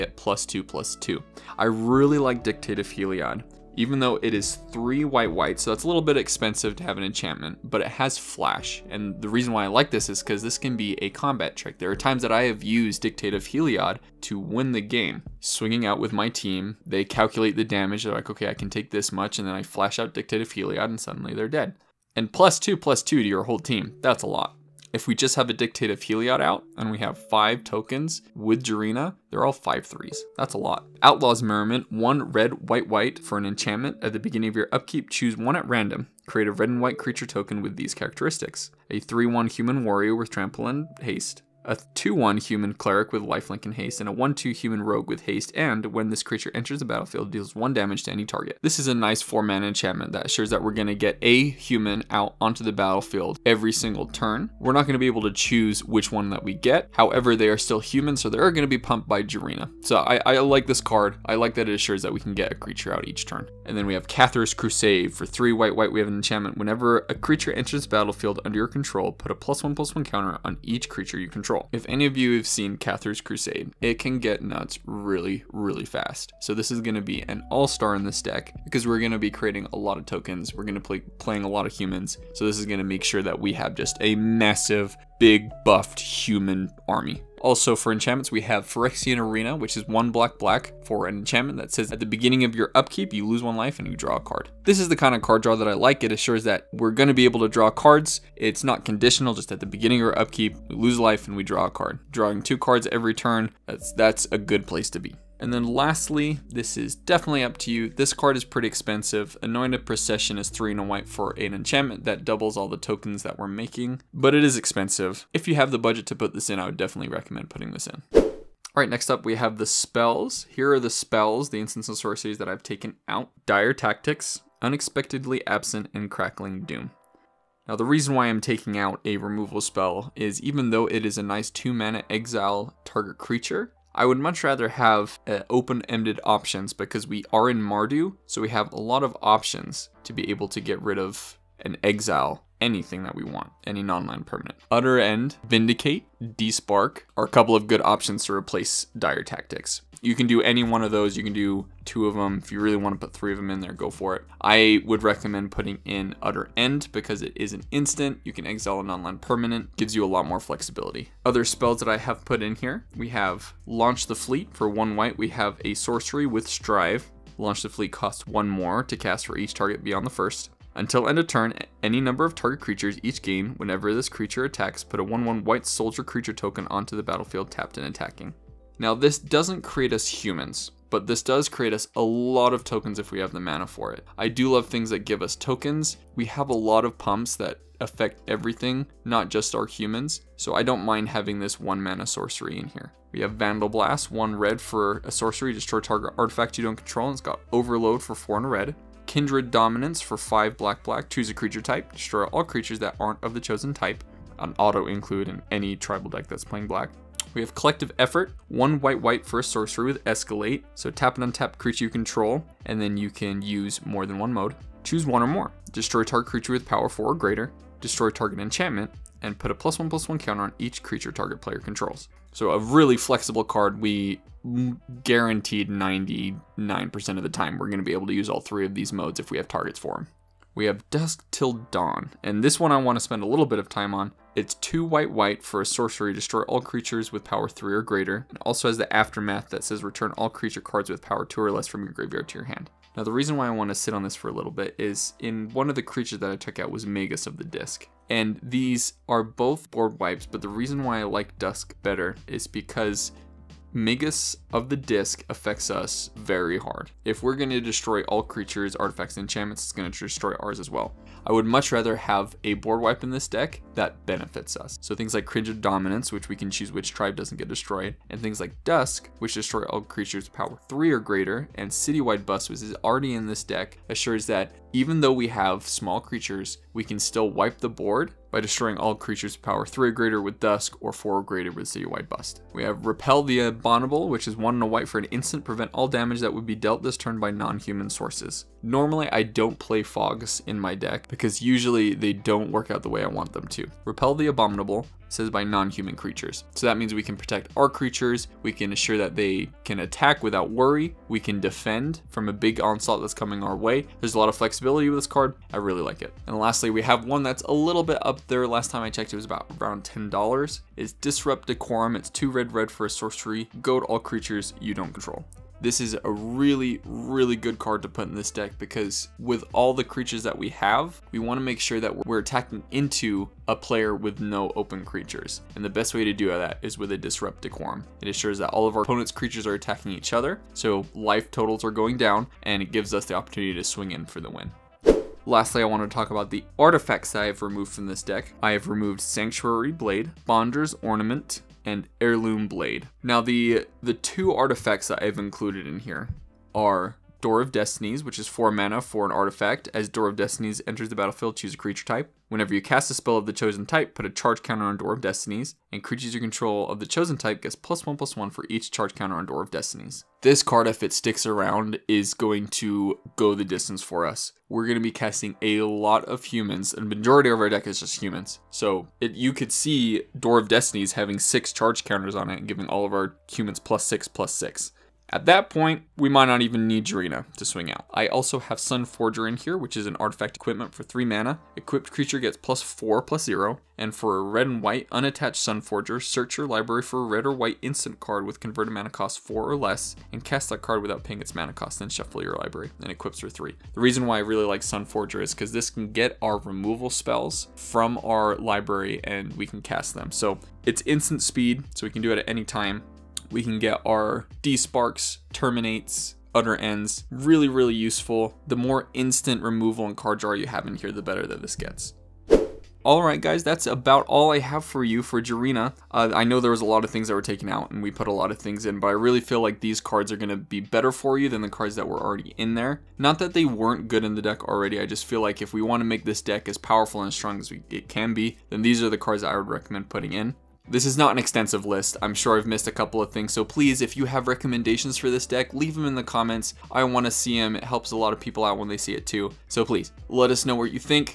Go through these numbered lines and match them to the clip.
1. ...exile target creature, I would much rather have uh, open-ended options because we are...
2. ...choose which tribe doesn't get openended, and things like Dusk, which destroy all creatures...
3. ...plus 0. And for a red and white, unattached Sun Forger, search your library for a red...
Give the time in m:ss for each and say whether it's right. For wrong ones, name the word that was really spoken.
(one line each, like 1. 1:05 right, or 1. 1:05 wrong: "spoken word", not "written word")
1. 2:12 right
2. 4:26 wrong: "destroyed", not "openended"
3. 6:23 right.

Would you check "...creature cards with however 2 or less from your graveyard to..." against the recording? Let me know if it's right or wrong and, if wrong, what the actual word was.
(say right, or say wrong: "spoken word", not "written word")
wrong: "power", not "however".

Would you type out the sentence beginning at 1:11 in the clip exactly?
If any of you have seen Cathar's Crusade, it can get nuts really, really fast.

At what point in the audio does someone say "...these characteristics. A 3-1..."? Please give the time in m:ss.
0:37.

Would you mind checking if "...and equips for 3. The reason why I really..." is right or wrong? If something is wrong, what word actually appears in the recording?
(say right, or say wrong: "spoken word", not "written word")
right.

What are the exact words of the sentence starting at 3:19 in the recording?
Kindred Dominance for 5 black black.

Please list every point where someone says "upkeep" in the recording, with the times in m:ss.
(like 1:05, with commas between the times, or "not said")
0:34, 1:32, 1:40.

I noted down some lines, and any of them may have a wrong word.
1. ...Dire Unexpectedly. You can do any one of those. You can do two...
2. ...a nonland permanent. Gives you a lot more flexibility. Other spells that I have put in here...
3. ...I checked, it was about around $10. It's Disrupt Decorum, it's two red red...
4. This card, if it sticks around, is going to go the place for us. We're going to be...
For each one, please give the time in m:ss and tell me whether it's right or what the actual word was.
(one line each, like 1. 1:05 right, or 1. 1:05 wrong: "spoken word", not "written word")
1. 2:28 wrong: "Tactics", not "Unexpectedly"
2. 2:38 right
3. 5:08 right
4. 6:00 wrong: "distance", not "place".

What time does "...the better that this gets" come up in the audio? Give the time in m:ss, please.
6:50.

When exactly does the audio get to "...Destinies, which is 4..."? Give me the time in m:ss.
5:47.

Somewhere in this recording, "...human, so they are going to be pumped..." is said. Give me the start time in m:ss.
0:57.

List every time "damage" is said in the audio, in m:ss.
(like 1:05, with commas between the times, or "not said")
0:17, 0:47, 4:45.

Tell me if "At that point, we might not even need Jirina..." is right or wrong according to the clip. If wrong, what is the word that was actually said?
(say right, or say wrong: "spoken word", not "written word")
right.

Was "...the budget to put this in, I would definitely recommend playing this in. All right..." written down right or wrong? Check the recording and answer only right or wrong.
wrong.